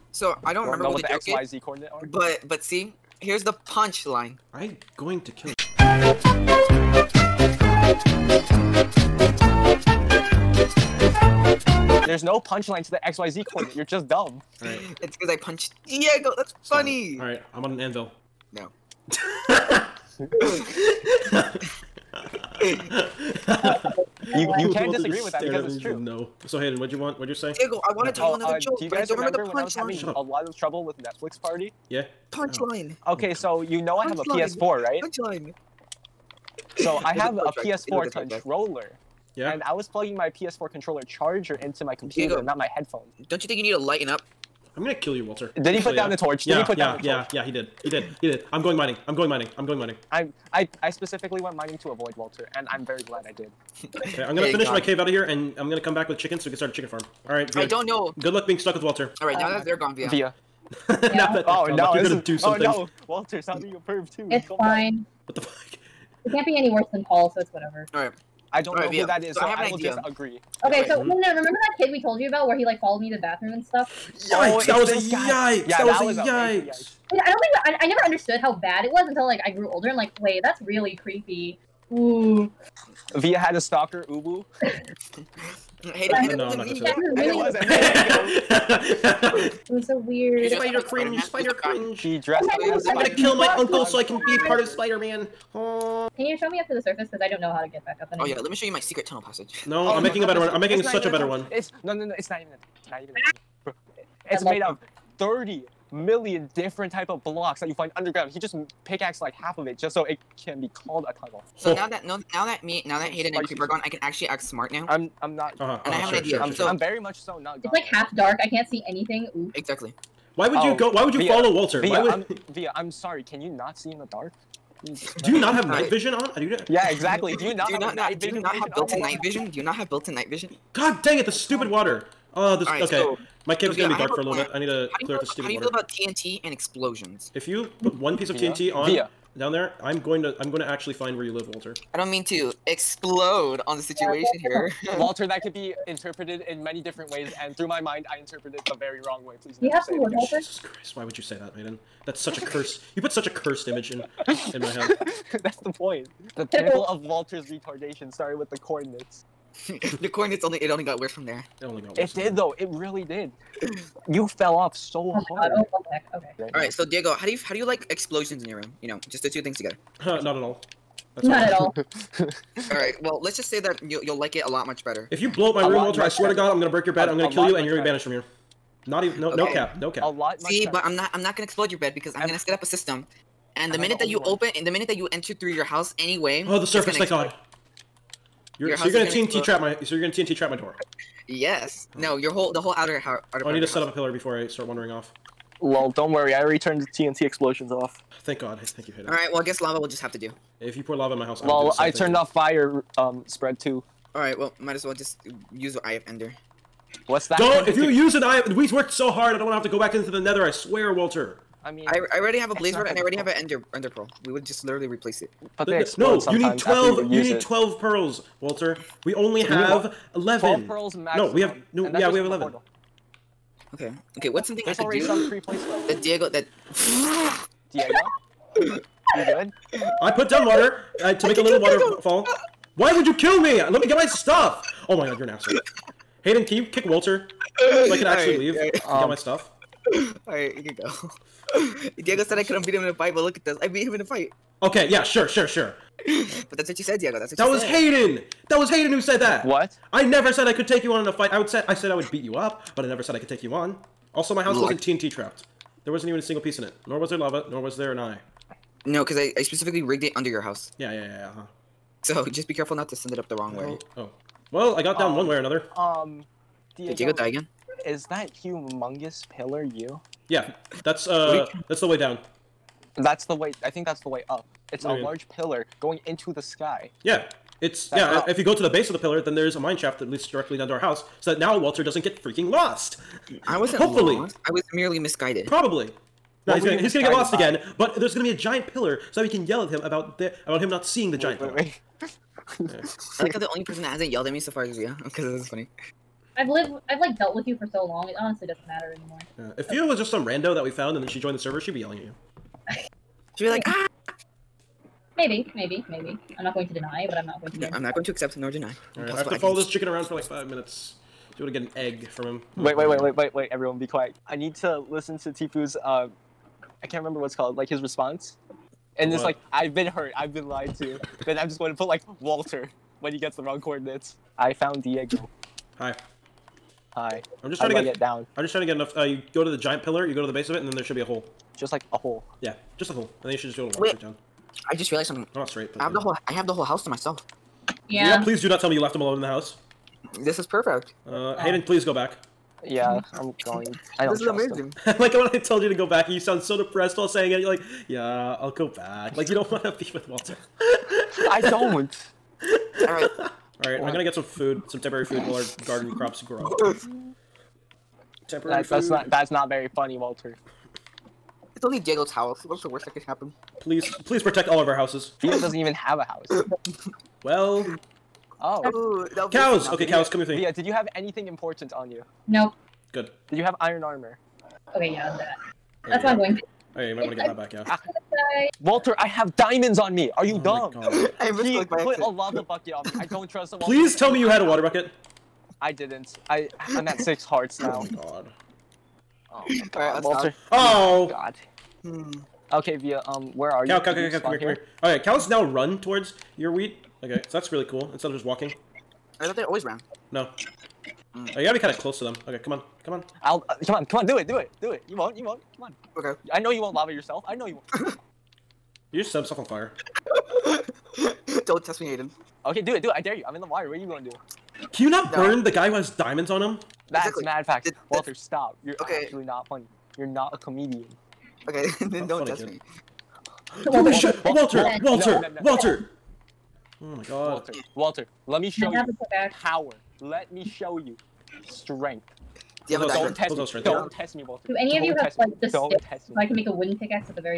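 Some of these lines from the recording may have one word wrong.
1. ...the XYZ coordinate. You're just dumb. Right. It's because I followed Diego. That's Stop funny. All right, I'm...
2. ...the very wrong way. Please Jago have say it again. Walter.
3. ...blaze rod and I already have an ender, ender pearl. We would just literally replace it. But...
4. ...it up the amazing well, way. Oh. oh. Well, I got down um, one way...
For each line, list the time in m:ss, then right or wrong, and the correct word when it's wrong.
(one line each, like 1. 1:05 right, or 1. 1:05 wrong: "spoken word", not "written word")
1. 0:12 wrong: "punched", not "followed"
2. 2:28 wrong: "You", not "Jago"
3. 3:32 right
4. 4:23 wrong: "wrong", not "amazing".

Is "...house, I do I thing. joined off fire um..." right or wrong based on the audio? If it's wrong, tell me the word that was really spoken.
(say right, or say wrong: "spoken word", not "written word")
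wrong: "turned", not "joined".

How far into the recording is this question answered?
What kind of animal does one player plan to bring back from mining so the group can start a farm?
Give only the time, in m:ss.
0:56.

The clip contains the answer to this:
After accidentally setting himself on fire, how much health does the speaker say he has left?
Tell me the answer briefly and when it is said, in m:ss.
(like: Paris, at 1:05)
6 hearts, at 6:26.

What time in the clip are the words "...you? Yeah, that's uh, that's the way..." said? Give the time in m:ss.
4:29.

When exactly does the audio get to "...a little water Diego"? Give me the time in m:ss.
3:51.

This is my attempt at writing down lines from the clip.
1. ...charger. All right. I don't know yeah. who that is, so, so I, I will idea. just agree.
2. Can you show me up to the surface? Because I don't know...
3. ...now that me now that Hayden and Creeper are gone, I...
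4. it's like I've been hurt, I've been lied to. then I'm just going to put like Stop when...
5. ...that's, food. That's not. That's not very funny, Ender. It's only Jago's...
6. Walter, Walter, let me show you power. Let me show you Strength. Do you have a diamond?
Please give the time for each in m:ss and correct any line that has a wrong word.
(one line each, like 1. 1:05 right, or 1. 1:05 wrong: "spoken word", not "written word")
1. 1:07 wrong: "whatever", not "charger"
2. 1:36 right
3. 1:52 right
4. 5:19 wrong: "Walter", not "Stop"
5. 5:58 wrong: "Walter", not "Ender"
6. 7:07 right.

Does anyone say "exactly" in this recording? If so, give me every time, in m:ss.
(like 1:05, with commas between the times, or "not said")
1:59, 2:06, 6:57.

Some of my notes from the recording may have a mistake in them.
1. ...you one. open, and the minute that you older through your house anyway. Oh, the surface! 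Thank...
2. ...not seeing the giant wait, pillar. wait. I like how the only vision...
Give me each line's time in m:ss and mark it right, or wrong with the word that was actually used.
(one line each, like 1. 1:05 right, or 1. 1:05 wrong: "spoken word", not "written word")
1. 3:04 wrong: "enter", not "older"
2. 4:50 wrong: "person", not "vision".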